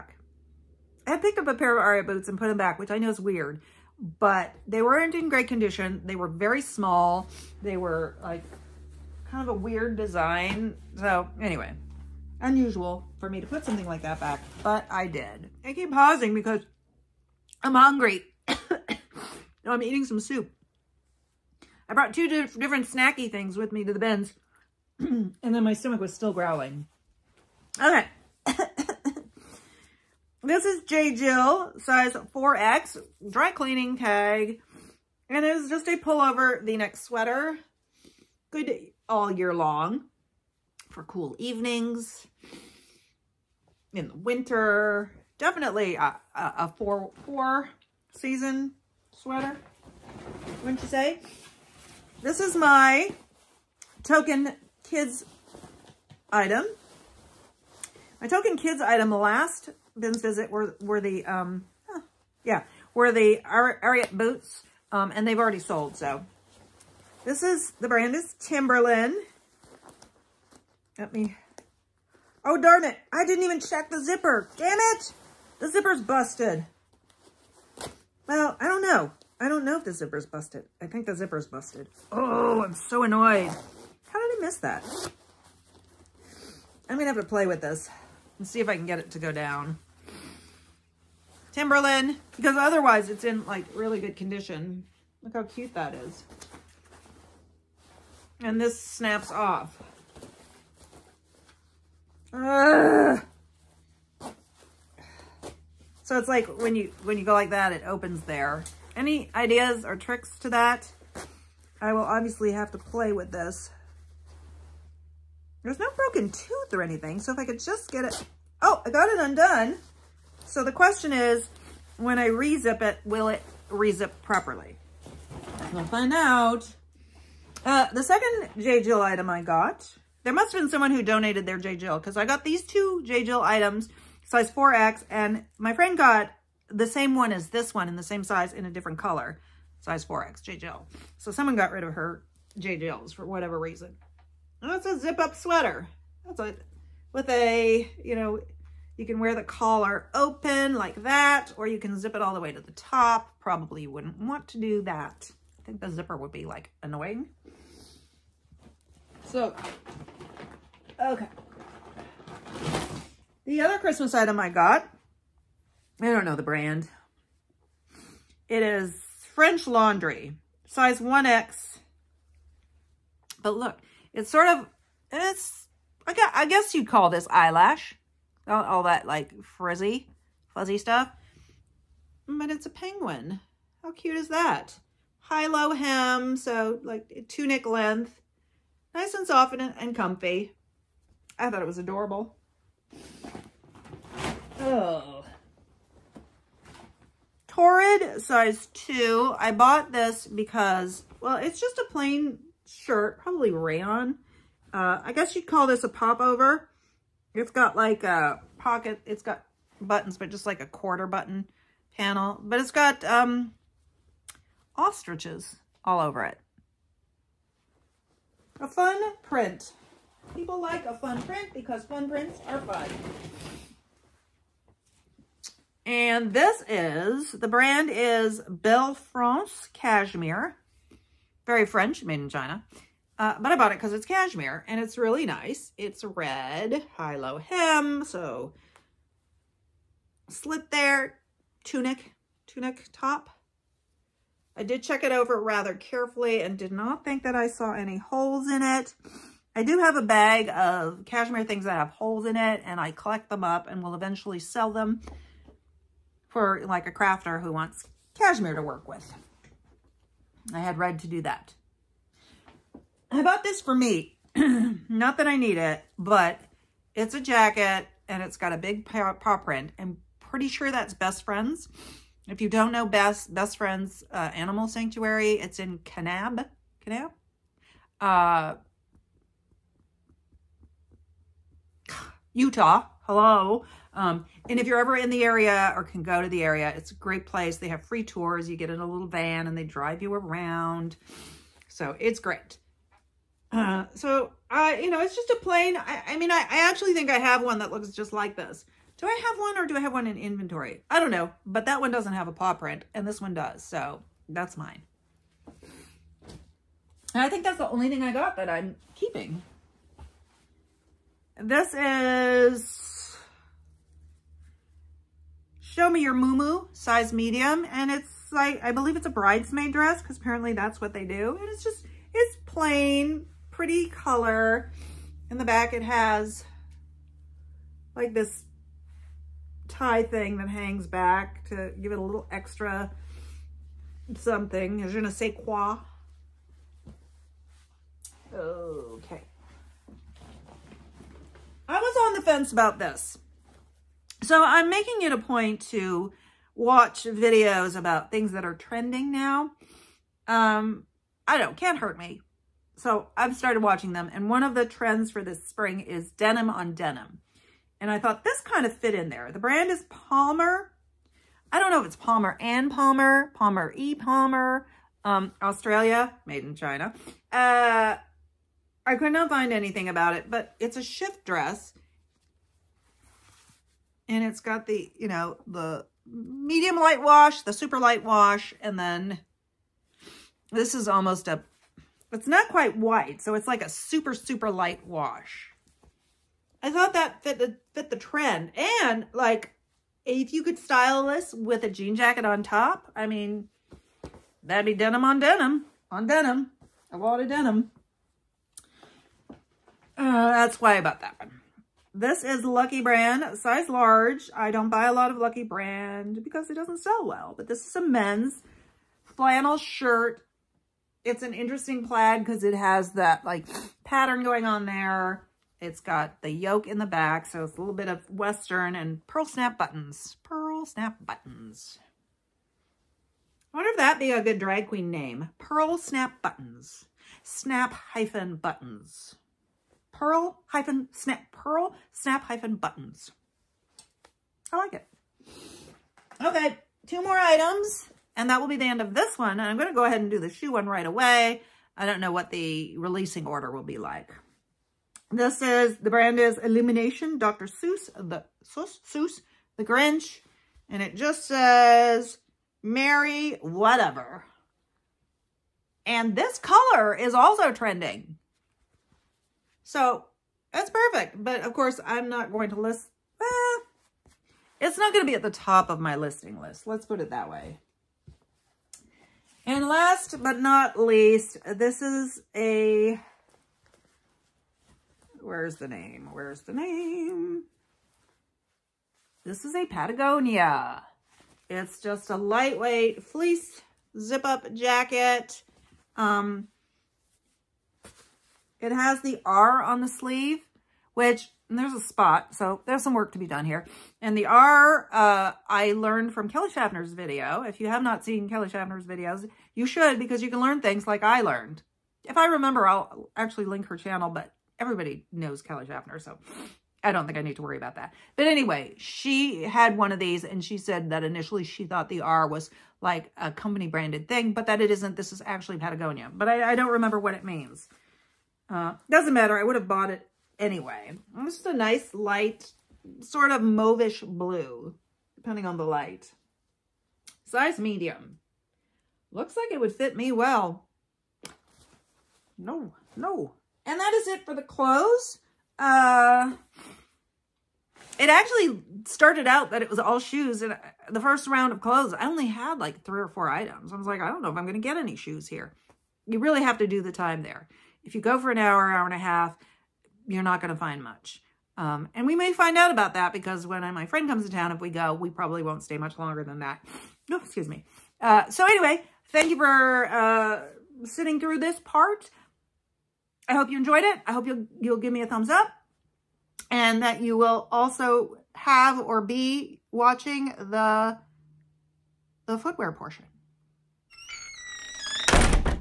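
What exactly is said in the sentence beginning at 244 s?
I did check it over rather carefully and did not think that I saw any holes in it.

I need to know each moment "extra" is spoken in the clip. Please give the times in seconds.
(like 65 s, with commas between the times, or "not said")
332 s.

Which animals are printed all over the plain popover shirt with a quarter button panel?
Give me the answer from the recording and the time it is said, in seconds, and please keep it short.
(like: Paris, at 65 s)
Ostriches, at 214 s.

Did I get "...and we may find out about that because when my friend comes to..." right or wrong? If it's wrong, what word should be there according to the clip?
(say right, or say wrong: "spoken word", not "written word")
right.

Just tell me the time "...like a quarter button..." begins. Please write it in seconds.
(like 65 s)
210 s.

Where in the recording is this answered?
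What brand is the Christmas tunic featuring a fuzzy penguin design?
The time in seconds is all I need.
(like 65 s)
169 s.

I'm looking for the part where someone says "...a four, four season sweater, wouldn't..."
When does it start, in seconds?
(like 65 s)
46 s.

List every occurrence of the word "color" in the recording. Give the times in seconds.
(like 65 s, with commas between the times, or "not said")
138 s, 323 s, 456 s.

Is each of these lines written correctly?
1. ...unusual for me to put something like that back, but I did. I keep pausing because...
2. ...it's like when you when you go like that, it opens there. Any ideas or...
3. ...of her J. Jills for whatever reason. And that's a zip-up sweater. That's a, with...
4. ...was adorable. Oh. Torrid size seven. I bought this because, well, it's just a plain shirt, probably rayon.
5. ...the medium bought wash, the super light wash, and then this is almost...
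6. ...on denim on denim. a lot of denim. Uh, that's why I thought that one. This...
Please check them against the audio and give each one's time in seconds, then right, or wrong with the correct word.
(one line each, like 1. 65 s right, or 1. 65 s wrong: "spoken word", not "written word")
1. 12 s right
2. 106 s right
3. 141 s right
4. 191 s wrong: "two", not "seven"
5. 375 s wrong: "light", not "bought"
6. 395 s wrong: "bought", not "thought".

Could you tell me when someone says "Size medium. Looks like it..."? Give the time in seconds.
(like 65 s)
527 s.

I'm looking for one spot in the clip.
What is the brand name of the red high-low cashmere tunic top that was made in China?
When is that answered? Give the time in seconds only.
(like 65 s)
228 s.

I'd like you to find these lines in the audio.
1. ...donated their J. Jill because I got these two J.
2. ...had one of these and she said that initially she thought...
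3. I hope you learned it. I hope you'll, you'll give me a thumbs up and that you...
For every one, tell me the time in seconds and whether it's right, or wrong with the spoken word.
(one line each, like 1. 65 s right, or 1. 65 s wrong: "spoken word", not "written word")
1. 131 s right
2. 509 s right
3. 563 s wrong: "enjoyed", not "learned".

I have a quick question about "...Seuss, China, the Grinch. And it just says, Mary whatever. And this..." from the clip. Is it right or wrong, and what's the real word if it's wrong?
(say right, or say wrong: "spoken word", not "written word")
wrong: "Seuss", not "China".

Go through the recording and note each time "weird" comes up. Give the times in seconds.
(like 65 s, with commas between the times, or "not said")
3 s, 9 s.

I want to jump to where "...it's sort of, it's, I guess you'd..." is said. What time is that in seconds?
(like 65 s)
174 s.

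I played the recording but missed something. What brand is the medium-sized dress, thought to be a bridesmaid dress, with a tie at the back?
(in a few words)
Show Me Your Mumu.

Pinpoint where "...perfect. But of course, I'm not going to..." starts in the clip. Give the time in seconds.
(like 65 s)
460 s.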